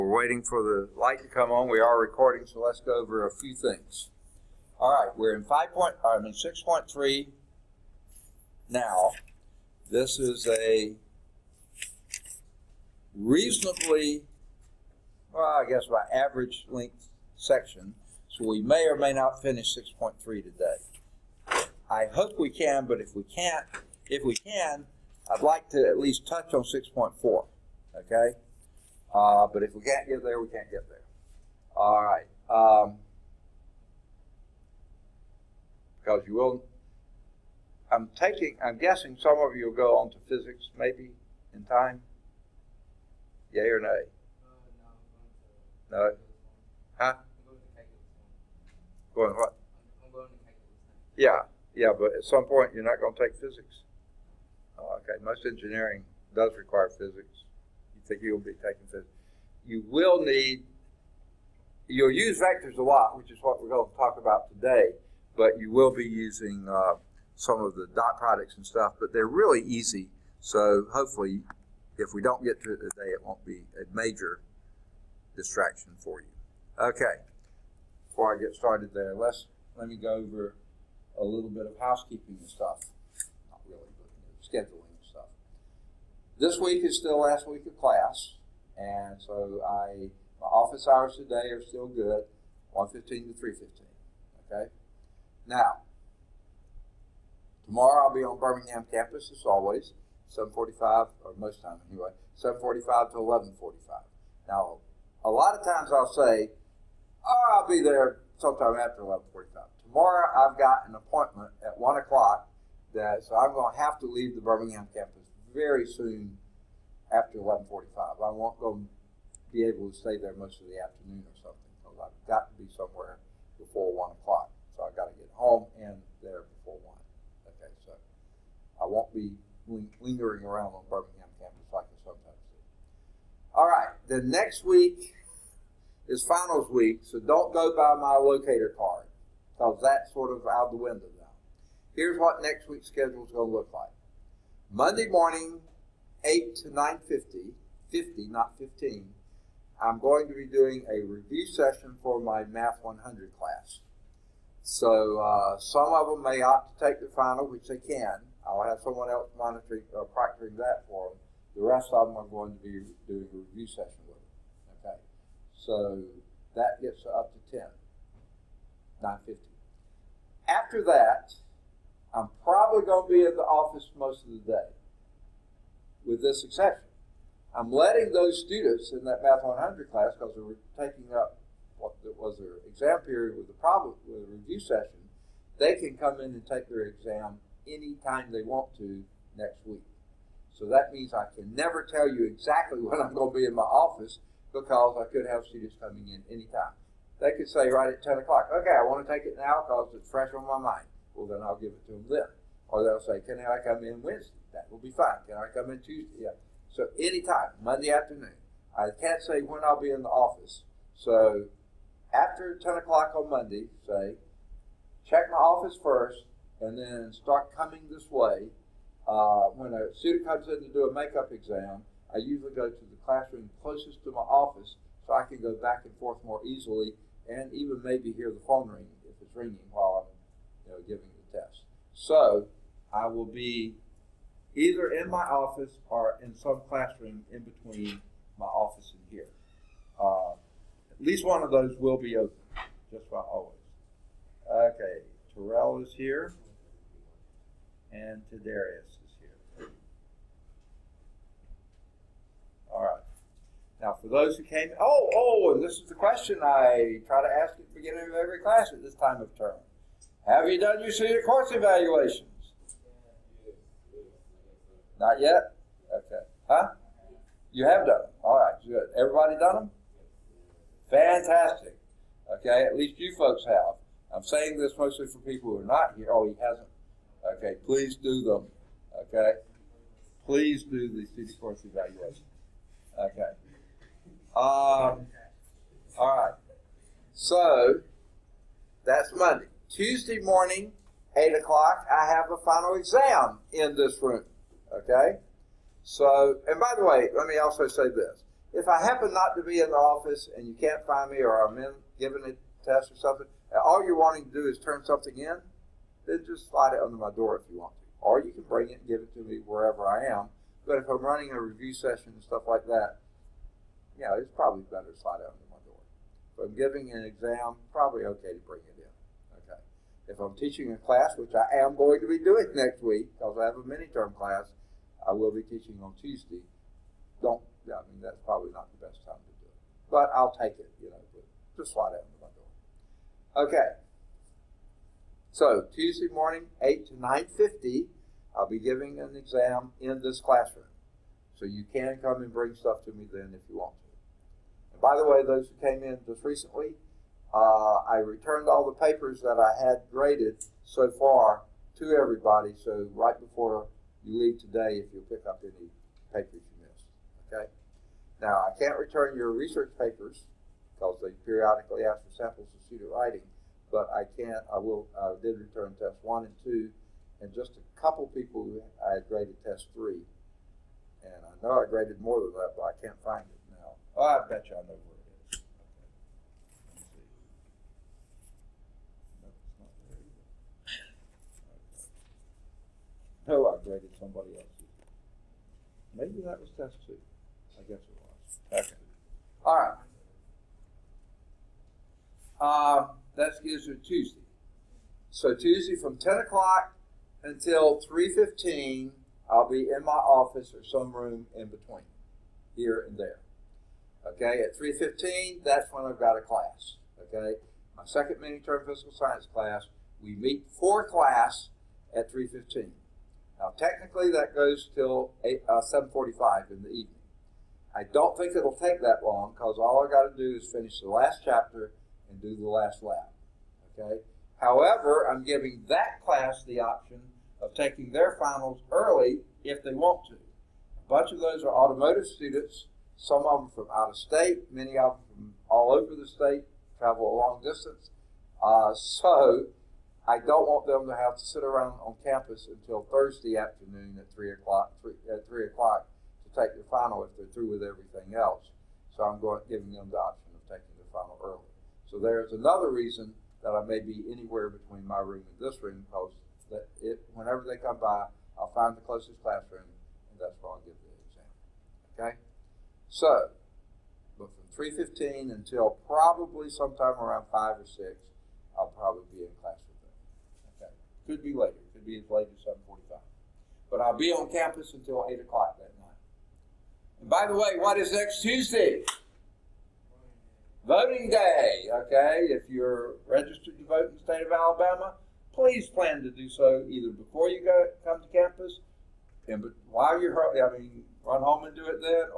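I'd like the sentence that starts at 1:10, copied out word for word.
So hopefully, if we don't get to it today, it won't be a major distraction for you.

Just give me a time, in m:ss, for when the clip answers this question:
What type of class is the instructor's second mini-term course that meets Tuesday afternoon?
6:48.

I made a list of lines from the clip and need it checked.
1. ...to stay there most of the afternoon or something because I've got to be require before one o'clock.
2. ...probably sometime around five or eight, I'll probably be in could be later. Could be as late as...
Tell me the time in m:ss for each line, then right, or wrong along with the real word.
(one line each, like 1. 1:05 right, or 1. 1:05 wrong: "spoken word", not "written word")
1. 1:59 wrong: "somewhere", not "require"
2. 7:45 wrong: "six", not "eight".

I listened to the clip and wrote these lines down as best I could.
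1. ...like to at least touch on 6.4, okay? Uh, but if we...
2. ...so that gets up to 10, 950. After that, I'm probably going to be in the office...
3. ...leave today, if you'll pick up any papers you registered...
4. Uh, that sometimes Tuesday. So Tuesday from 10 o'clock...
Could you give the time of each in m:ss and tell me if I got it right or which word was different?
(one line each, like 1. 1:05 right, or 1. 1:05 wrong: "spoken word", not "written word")
1. 0:25 right
2. 2:45 right
3. 5:54 wrong: "missed", not "registered"
4. 6:32 wrong: "gives", not "sometimes".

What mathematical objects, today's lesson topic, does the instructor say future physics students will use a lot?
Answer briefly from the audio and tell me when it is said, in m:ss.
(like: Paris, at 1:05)
vectors, at 1:02.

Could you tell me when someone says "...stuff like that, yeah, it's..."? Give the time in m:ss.
5:12.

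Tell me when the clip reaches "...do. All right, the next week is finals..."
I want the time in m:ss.
2:12.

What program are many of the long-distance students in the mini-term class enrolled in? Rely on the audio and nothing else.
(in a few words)
automotive.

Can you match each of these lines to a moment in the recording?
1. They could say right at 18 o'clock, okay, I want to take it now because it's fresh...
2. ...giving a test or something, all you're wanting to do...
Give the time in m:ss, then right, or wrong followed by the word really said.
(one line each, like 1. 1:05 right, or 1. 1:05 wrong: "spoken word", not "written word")
1. 3:17 wrong: "10", not "18"
2. 5:01 right.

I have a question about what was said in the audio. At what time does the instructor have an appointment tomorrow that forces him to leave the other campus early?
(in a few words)
1 o'clock.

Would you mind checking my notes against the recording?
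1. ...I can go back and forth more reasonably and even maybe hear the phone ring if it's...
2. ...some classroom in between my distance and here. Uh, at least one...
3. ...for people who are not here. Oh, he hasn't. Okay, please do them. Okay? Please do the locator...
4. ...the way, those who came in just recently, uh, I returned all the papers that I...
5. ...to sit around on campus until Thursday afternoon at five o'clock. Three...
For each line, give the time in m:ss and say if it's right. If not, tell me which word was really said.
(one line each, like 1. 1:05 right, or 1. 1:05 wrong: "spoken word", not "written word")
1. 3:45 wrong: "easily", not "reasonably"
2. 3:56 wrong: "office", not "distance"
3. 4:35 wrong: "senior", not "locator"
4. 5:44 right
5. 7:21 wrong: "three", not "five".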